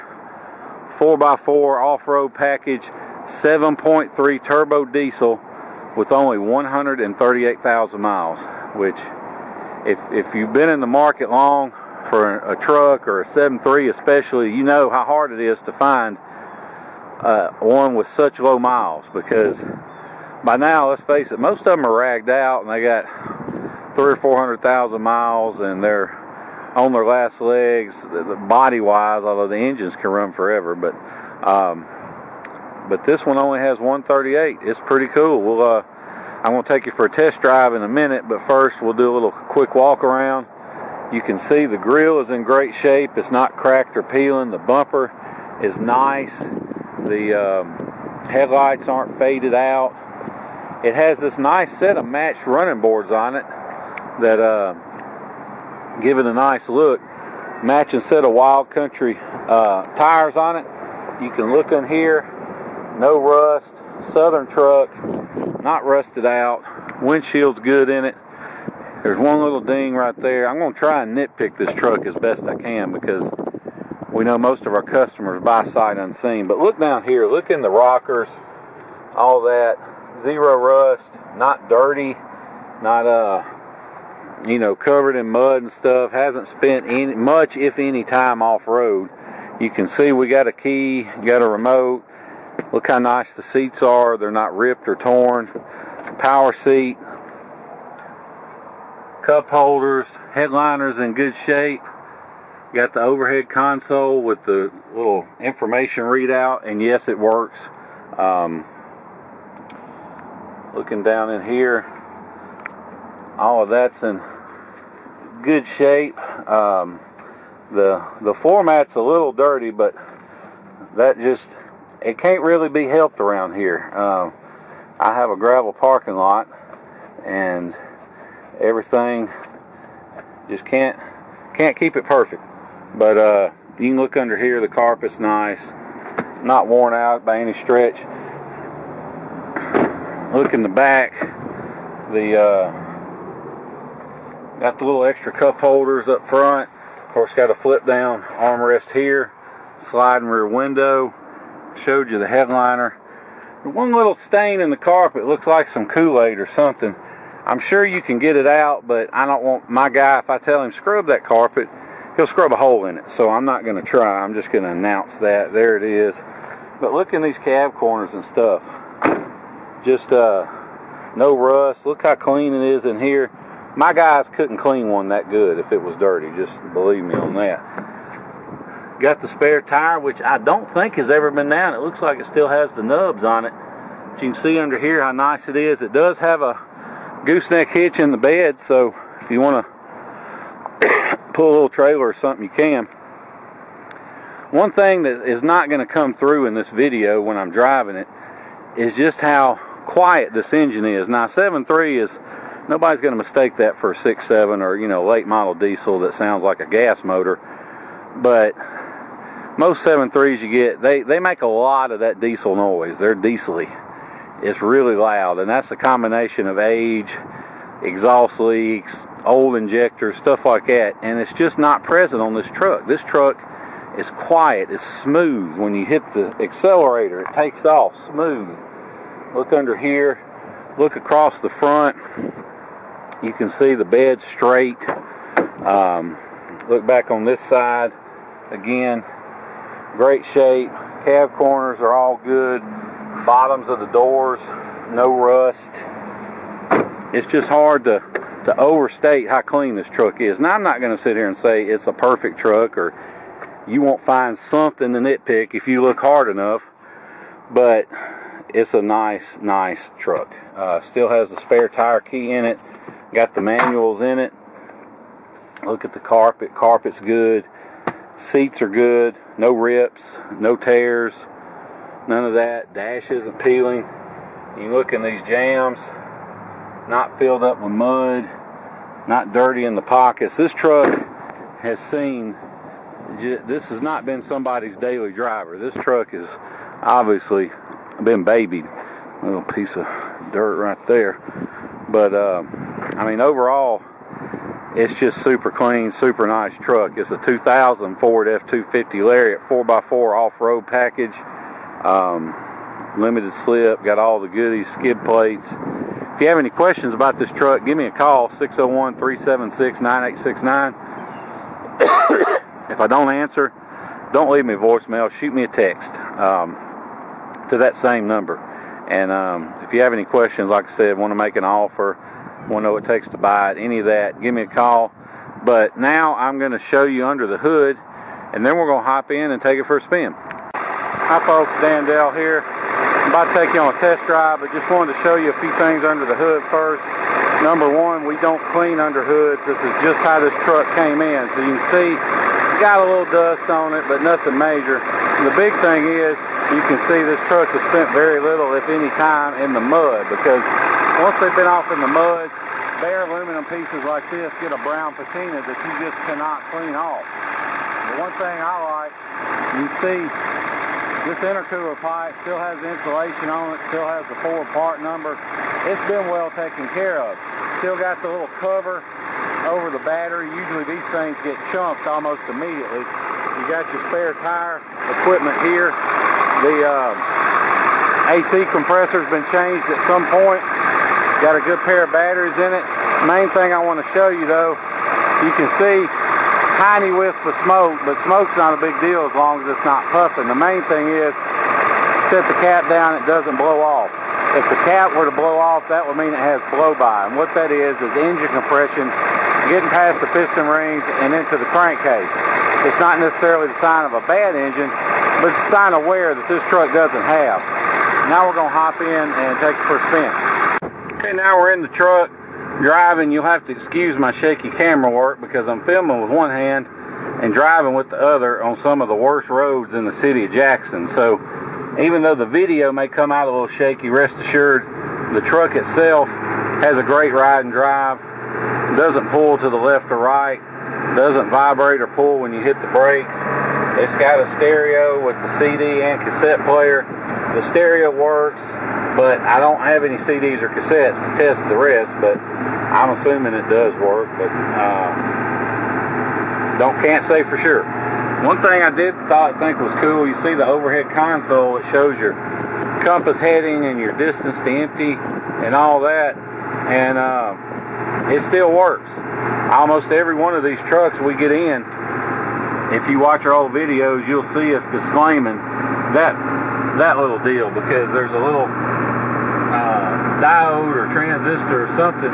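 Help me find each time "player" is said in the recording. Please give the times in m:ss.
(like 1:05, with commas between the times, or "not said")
7:16.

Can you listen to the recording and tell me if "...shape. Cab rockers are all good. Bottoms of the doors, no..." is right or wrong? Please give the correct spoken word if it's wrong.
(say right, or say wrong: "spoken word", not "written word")
wrong: "corners", not "rockers".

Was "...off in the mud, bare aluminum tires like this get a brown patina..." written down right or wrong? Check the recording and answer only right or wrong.
wrong.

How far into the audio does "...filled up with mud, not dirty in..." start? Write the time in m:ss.
4:37.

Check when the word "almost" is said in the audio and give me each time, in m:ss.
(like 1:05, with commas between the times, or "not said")
6:11, 7:39.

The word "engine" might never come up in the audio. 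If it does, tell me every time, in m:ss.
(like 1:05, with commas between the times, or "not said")
0:29, 3:20, 6:37, 6:44.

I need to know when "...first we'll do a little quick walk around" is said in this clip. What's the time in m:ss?
0:38.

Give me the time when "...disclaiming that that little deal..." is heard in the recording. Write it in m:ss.
7:44.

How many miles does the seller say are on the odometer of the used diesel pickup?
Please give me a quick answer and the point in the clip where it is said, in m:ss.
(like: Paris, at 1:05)
138,000, at 0:06.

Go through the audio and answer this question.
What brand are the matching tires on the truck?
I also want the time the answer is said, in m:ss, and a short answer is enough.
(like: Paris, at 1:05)
Wild Country, at 0:58.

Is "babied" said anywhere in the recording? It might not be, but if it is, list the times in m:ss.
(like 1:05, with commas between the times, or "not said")
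4:48.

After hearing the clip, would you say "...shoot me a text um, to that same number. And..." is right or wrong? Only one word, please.
right.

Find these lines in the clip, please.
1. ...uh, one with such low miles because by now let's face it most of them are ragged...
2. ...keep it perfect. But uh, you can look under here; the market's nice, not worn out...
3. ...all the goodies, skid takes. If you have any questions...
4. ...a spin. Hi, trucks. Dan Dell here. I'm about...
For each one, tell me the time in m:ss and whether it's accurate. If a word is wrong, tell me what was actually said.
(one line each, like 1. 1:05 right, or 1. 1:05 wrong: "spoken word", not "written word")
1. 0:17 right
2. 2:11 wrong: "carpet", not "market"
3. 5:03 wrong: "plates", not "takes"
4. 5:29 wrong: "folks", not "trucks".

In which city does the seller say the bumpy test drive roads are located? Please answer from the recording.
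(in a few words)
Jackson.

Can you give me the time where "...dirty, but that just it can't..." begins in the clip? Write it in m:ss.
1:59.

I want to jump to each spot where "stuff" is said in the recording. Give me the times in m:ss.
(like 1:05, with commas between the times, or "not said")
1:25, 2:48, 3:40.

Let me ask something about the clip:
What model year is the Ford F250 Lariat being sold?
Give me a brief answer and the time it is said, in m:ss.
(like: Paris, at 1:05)
2000, at 4:57.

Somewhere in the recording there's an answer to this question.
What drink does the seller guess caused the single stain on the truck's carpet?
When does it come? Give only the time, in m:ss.
2:35.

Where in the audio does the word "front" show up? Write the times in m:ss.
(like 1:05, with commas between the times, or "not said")
2:26, 3:51.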